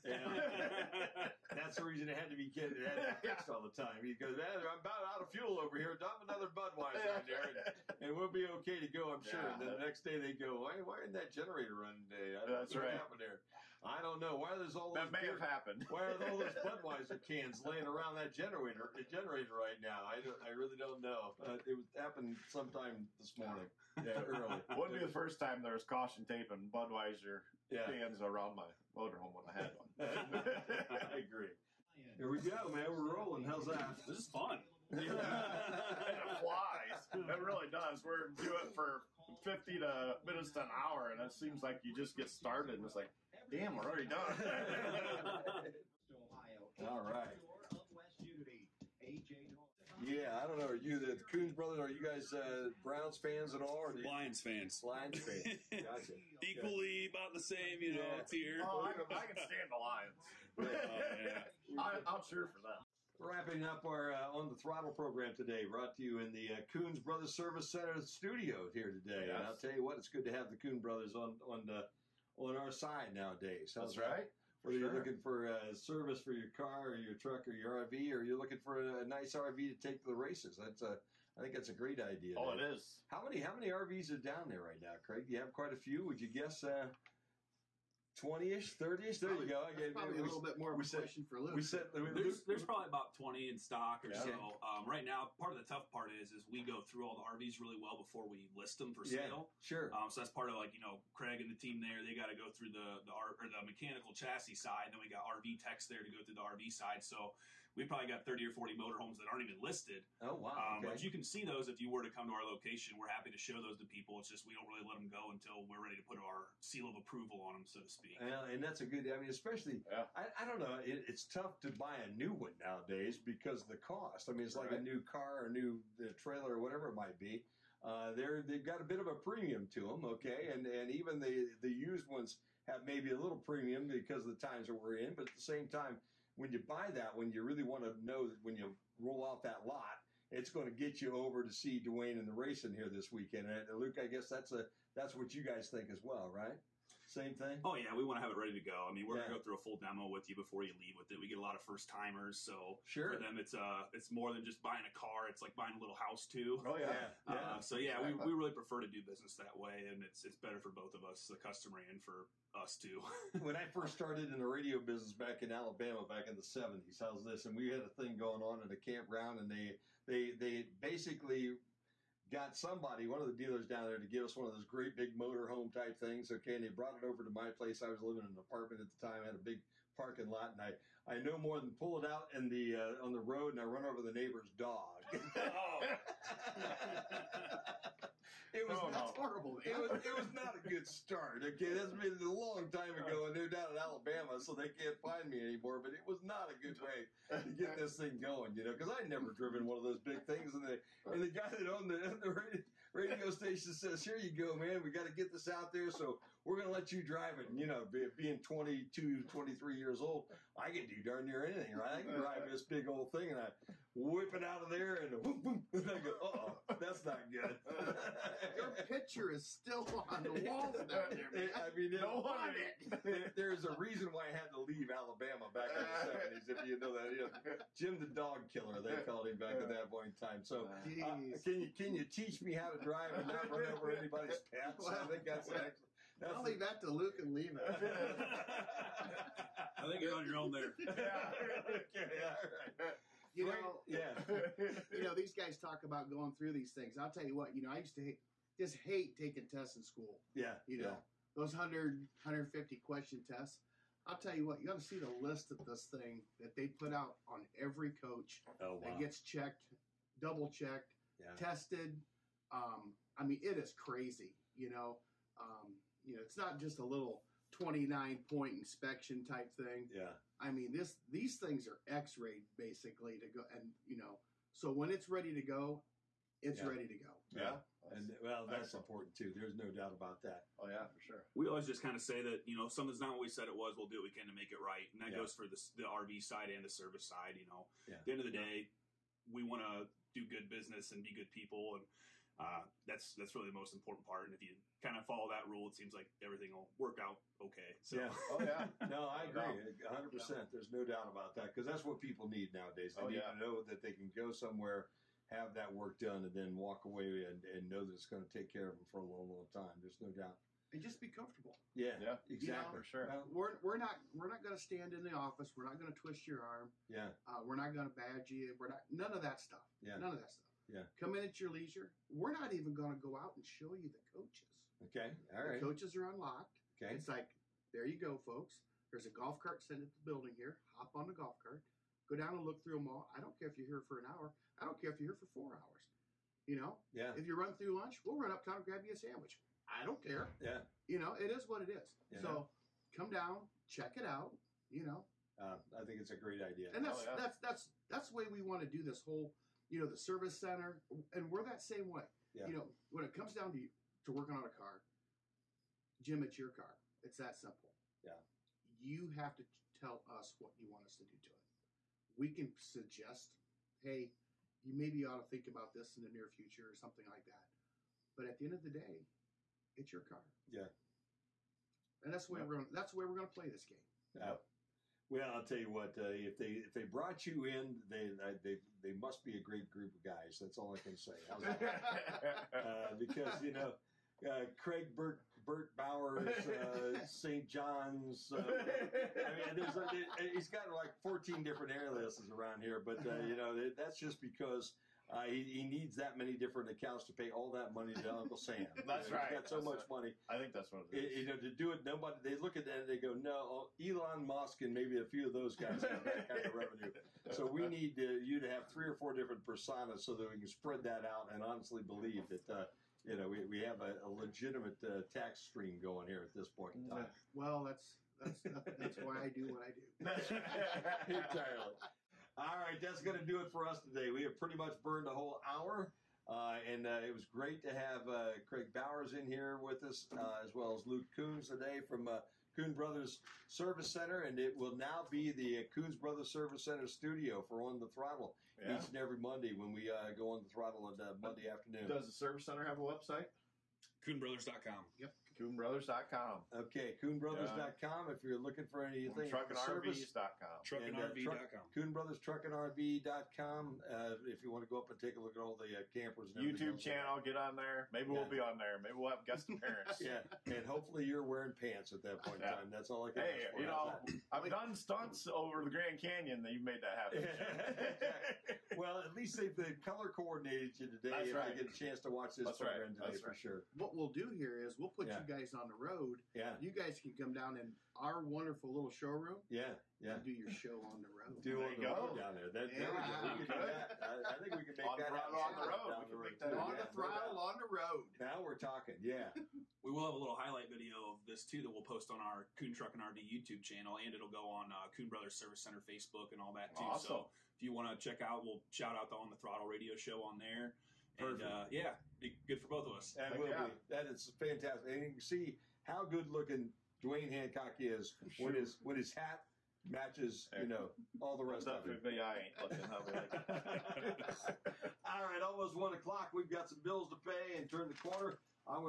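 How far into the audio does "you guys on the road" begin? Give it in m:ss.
7:55.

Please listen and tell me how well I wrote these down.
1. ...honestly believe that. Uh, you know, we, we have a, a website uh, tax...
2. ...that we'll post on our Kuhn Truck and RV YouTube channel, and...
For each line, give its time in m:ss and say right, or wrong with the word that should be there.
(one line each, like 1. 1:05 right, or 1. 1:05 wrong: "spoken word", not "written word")
1. 6:51 wrong: "legitimate", not "website"
2. 8:11 right.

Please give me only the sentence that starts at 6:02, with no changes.
We can suggest, hey, you maybe ought to think about this in the near future or something like that.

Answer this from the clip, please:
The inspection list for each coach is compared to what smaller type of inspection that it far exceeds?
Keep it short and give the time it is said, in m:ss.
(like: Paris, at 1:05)
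29 point inspection, at 4:27.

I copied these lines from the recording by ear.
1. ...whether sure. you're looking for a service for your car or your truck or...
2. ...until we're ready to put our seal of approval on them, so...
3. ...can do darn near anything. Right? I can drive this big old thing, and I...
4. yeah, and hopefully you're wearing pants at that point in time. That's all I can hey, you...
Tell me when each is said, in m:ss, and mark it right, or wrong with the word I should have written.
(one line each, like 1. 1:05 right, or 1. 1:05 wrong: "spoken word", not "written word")
1. 1:14 right
2. 1:55 right
3. 3:30 right
4. 7:39 right.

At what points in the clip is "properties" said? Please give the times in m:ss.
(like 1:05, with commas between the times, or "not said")
not said.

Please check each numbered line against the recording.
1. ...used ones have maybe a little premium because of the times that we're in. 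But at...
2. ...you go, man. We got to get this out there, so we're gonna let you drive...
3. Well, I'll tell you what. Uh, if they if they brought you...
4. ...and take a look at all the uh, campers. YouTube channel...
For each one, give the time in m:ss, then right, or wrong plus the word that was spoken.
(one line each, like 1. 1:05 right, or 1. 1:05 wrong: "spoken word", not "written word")
1. 2:11 right
2. 3:24 right
3. 6:15 right
4. 7:34 right.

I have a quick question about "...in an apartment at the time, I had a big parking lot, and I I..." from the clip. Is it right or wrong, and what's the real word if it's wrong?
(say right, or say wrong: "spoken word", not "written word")
right.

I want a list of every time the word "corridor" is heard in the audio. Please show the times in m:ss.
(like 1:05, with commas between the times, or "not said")
not said.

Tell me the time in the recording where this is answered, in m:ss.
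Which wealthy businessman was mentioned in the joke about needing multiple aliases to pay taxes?
6:43.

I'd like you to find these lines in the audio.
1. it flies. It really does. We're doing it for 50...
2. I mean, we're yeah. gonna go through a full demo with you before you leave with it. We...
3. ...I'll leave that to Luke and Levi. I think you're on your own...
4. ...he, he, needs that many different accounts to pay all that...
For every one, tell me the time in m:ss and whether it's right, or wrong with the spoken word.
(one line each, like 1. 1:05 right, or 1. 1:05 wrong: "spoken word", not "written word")
1. 0:36 right
2. 2:28 right
3. 3:56 right
4. 6:35 right.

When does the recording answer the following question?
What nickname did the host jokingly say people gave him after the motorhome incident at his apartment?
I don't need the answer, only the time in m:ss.
3:47.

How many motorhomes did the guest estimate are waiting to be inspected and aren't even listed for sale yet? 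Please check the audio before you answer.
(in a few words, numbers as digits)
30 or 40.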